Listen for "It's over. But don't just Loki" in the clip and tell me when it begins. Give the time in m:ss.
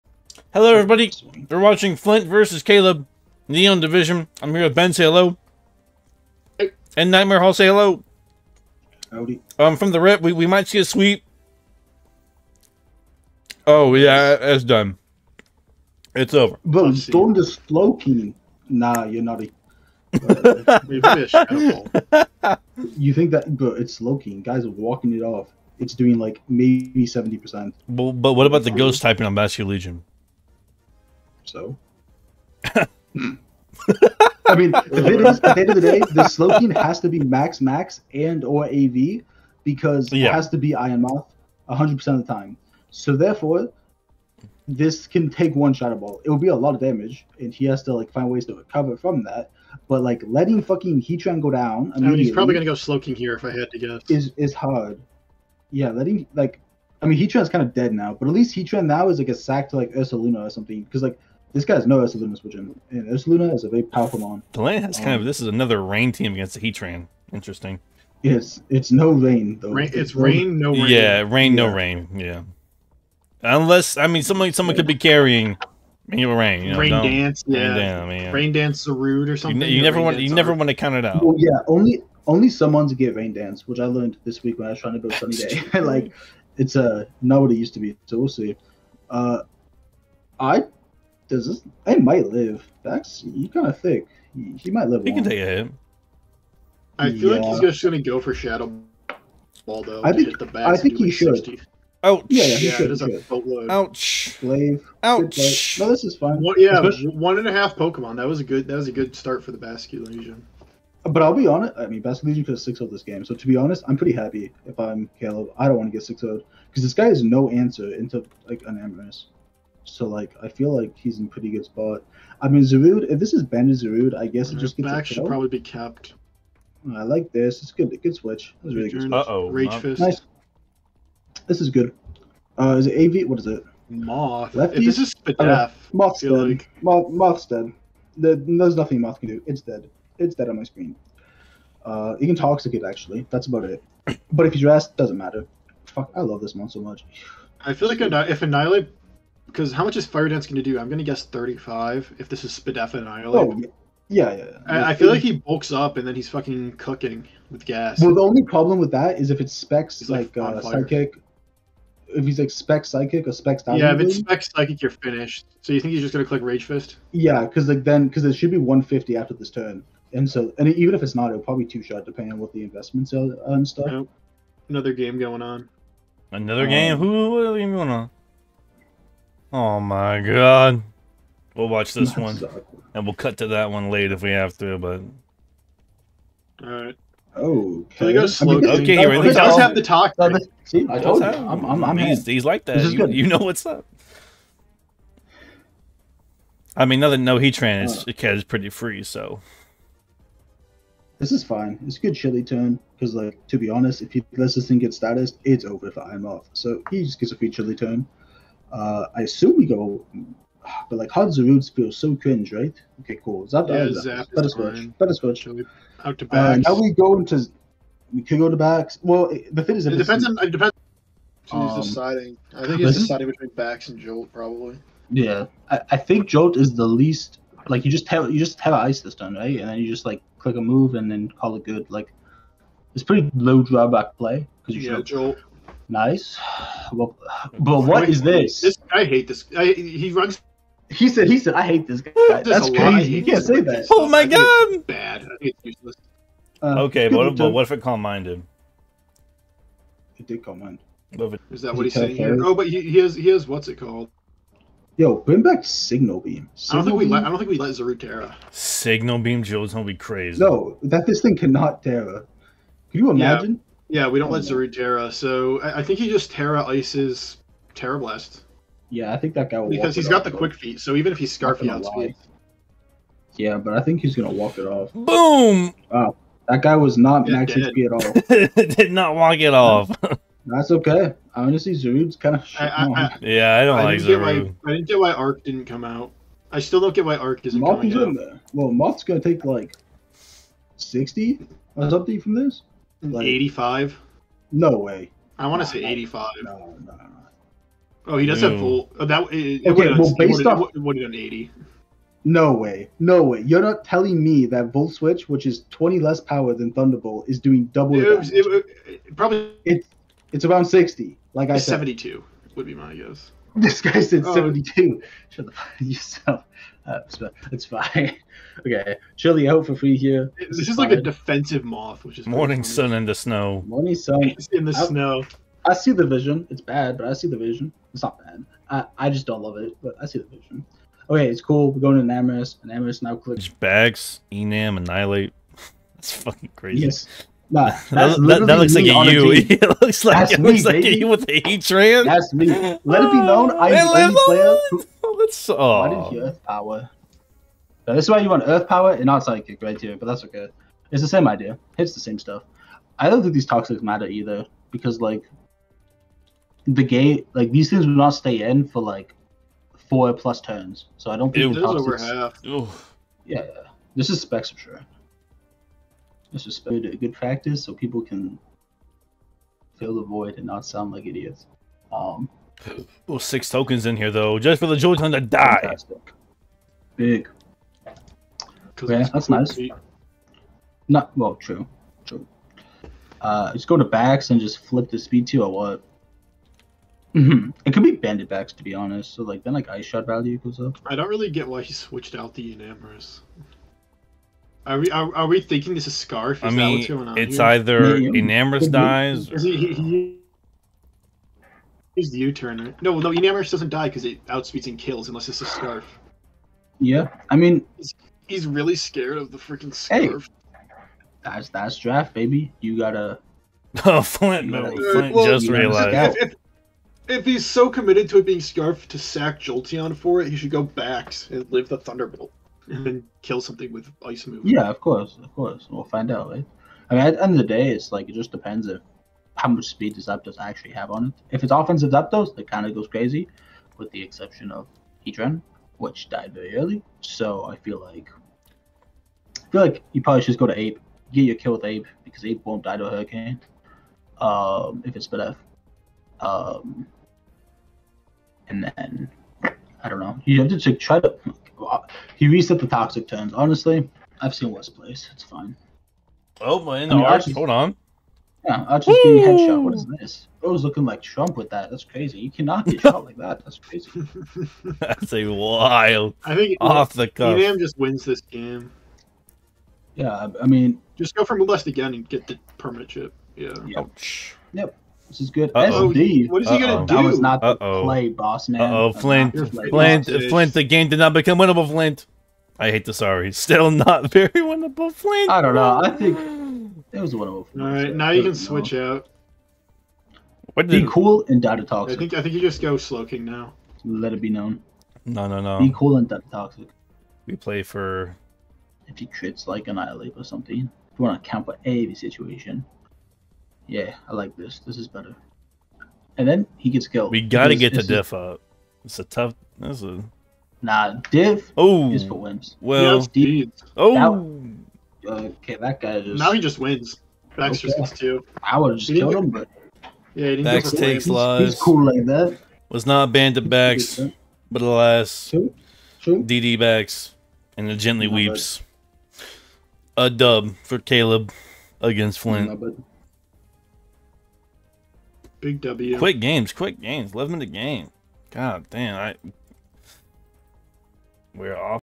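0:16.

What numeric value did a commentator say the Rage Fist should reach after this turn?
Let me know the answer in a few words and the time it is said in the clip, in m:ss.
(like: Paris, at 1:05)
150, at 2:48.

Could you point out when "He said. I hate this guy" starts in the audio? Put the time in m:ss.
4:01.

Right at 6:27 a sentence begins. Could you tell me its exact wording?
It could be bandit backs to be honest.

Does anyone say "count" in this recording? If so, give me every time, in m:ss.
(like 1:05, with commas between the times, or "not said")
1:20, 8:21.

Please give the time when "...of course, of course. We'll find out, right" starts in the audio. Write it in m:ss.
7:04.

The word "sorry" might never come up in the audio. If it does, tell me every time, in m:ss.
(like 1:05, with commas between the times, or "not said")
8:02.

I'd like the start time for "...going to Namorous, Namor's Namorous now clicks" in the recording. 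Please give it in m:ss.
5:31.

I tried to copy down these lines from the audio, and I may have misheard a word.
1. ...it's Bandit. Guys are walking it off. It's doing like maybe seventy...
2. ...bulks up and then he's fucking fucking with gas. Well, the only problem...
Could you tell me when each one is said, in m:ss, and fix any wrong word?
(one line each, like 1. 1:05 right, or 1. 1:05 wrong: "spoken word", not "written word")
1. 0:23 wrong: "Loki", not "Bandit"
2. 2:35 wrong: "cooking", not "fucking".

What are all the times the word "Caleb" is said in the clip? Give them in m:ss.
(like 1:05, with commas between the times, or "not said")
0:02, 1:55, 8:50.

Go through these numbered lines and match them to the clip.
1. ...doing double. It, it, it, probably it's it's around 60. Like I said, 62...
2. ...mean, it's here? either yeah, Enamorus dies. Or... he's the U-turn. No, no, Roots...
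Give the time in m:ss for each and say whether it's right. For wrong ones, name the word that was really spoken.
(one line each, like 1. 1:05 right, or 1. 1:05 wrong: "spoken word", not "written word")
1. 5:07 wrong: "72", not "62"
2. 6:36 wrong: "Enamorus", not "Roots".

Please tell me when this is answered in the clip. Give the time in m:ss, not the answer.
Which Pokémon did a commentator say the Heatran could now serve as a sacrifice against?
0:59.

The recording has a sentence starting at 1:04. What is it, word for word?
Delaney has um, kind of um, this is another rain team against the Heatran.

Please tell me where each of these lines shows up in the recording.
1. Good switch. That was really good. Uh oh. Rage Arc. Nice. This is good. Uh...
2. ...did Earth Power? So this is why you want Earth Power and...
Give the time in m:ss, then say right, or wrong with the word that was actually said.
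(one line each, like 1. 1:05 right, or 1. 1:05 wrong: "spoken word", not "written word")
1. 2:08 wrong: "Fist", not "Arc"
2. 5:46 right.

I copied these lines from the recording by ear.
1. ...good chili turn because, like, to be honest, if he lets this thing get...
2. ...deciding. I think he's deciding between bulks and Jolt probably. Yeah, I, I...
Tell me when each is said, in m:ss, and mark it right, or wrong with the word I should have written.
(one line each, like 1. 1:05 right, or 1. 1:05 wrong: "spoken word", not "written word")
1. 3:22 right
2. 3:41 wrong: "backs", not "bulks".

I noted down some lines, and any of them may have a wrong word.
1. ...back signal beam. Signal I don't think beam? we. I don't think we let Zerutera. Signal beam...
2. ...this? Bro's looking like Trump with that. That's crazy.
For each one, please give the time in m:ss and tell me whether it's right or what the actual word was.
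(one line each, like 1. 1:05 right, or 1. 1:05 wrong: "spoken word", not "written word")
1. 4:15 right
2. 7:39 right.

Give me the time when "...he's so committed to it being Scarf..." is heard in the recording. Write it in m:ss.
6:57.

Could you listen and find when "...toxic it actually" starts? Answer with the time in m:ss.
2:22.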